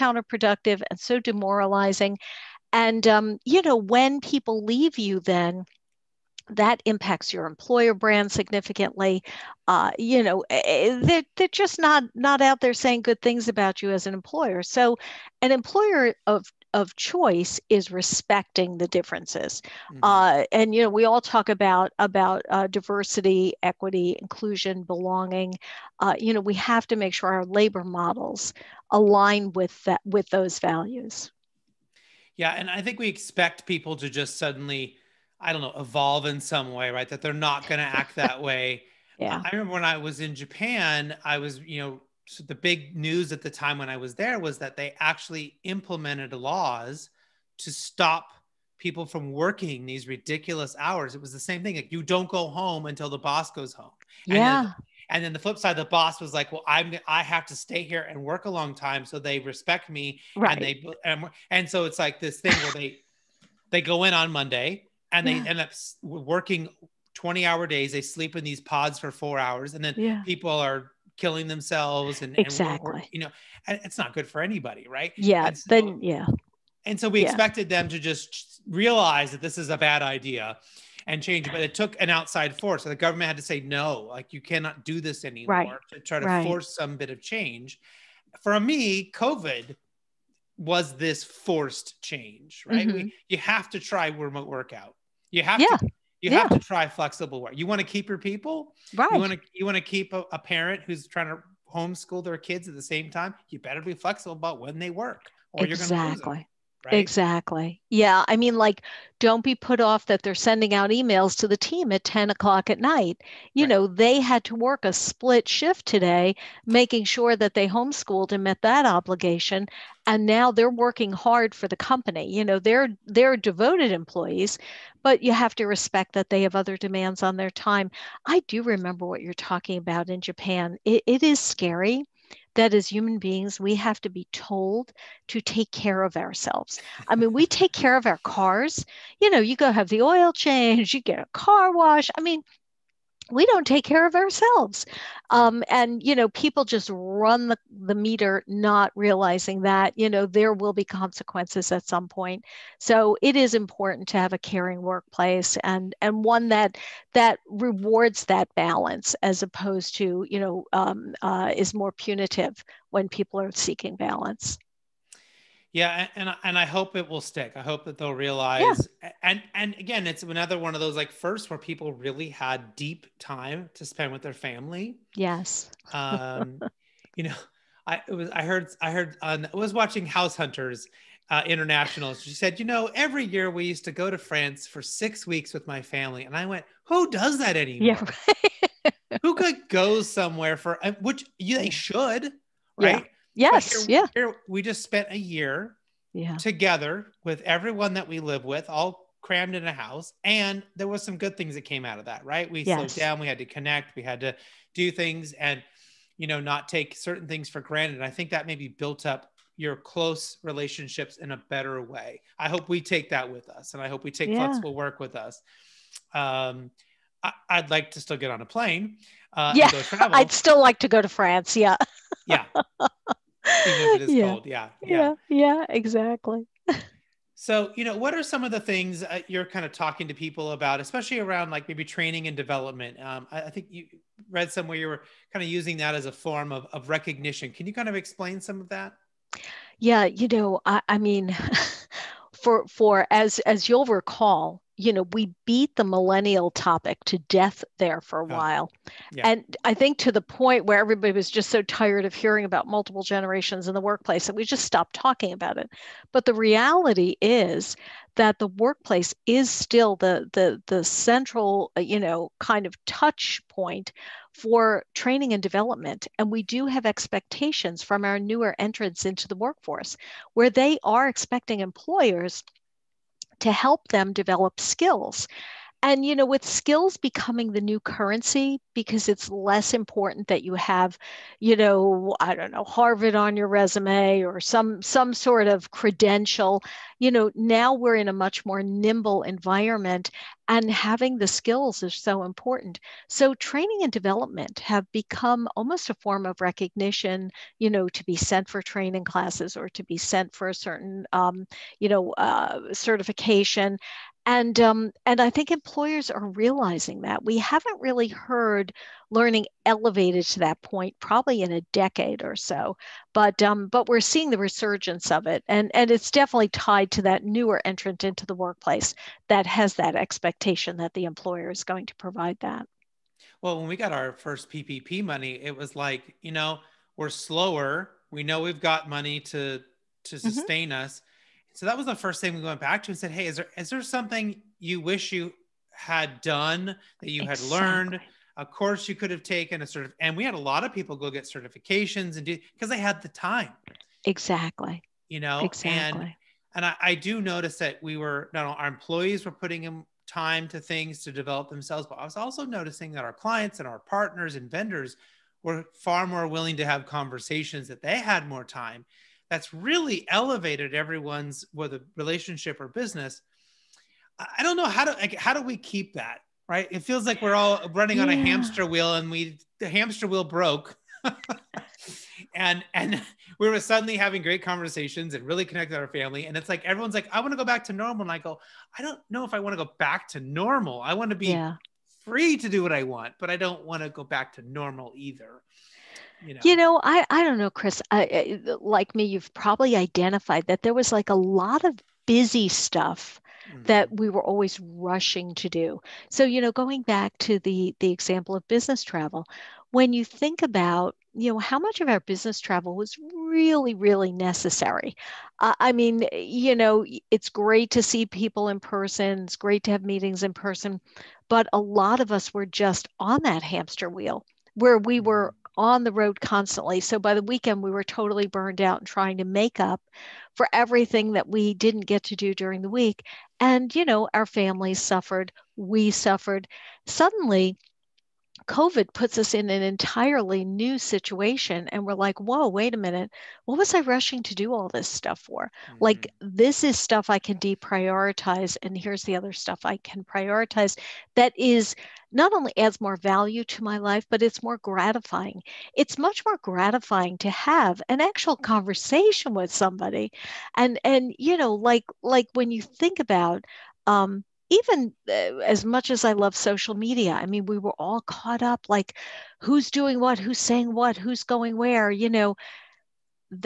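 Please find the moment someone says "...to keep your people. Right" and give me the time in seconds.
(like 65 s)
97 s.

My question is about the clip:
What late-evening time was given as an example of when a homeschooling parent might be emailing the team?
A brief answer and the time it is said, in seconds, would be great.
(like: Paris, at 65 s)
10 o'clock, at 112 s.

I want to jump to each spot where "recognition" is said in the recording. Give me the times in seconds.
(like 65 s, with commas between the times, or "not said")
236 s, 296 s.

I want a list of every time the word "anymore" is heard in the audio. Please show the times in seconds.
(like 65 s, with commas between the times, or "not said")
85 s, 187 s.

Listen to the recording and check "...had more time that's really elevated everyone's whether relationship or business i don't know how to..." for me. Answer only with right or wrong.
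right.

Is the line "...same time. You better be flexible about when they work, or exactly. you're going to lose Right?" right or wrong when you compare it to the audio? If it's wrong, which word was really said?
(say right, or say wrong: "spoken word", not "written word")
right.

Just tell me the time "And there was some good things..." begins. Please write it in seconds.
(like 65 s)
200 s.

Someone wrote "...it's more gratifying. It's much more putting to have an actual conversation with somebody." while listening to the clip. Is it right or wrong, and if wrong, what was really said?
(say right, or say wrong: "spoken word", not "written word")
wrong: "gratifying", not "putting".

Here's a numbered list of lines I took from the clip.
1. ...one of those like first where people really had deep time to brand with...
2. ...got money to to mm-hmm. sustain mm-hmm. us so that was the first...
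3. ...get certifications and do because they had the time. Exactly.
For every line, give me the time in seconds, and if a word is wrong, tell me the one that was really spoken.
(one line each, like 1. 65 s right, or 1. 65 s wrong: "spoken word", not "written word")
1. 170 s wrong: "spend", not "brand"
2. 328 s right
3. 341 s right.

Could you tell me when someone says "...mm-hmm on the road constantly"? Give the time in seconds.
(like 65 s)
415 s.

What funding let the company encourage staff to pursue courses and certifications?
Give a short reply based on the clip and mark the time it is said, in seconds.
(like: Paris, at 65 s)
PPP money, at 324 s.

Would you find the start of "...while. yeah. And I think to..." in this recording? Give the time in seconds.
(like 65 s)
248 s.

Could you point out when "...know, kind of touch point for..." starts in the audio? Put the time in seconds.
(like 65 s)
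261 s.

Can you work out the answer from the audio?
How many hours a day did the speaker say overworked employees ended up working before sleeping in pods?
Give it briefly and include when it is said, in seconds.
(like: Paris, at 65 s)
20, at 67 s.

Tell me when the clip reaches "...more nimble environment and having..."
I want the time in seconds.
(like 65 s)
288 s.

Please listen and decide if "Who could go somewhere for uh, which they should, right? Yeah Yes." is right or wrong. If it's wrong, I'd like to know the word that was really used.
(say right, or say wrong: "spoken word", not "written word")
right.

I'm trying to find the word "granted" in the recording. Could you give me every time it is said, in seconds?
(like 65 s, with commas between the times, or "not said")
207 s.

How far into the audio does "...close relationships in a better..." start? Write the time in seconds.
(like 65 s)
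209 s.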